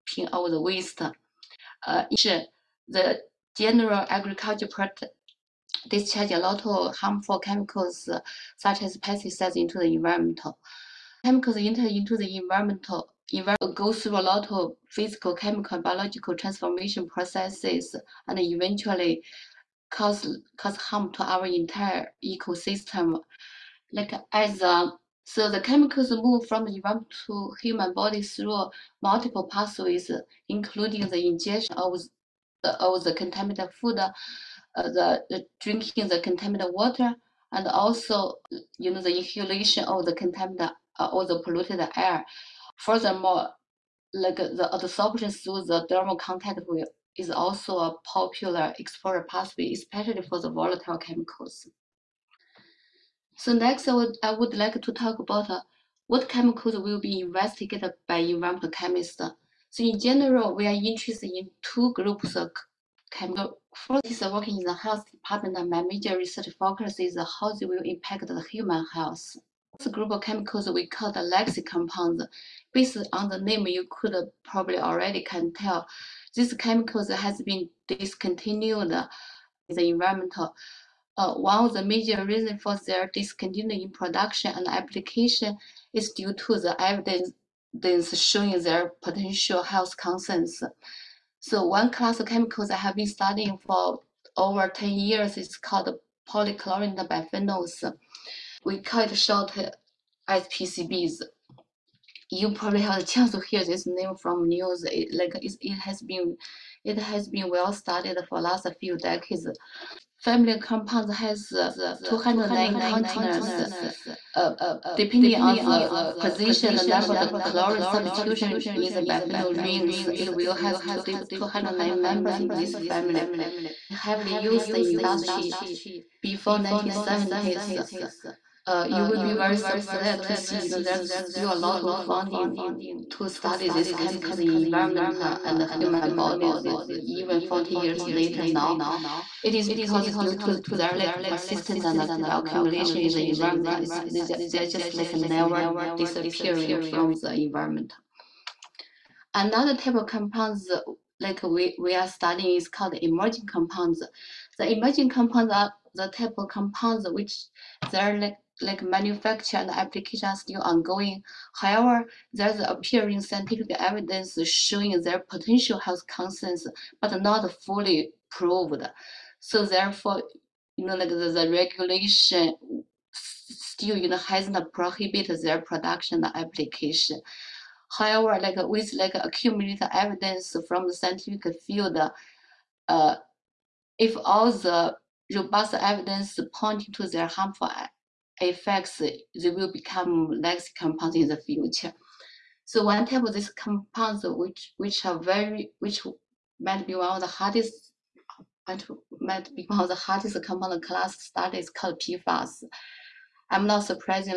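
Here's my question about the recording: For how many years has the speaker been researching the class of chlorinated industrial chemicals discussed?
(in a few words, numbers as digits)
over 10 years.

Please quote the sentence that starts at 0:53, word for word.
So next, I would, I would like to talk about uh, what chemicals will be investigated by environmental chemists.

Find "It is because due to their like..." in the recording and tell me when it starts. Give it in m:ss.
2:19.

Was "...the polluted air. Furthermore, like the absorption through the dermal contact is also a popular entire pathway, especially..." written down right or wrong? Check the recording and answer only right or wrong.
wrong.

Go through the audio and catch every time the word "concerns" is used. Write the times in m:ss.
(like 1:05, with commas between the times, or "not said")
1:29, 2:46.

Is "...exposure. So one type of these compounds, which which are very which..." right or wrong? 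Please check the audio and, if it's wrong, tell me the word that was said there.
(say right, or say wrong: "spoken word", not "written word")
wrong: "future", not "exposure".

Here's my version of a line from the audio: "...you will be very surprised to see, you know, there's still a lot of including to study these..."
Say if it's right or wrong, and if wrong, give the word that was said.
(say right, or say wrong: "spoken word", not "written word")
wrong: "funding", not "including".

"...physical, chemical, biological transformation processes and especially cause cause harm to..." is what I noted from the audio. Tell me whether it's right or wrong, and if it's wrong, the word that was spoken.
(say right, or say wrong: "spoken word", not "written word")
wrong: "eventually", not "especially".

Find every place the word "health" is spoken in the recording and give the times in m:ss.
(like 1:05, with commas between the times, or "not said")
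1:04, 1:08, 1:29, 2:45.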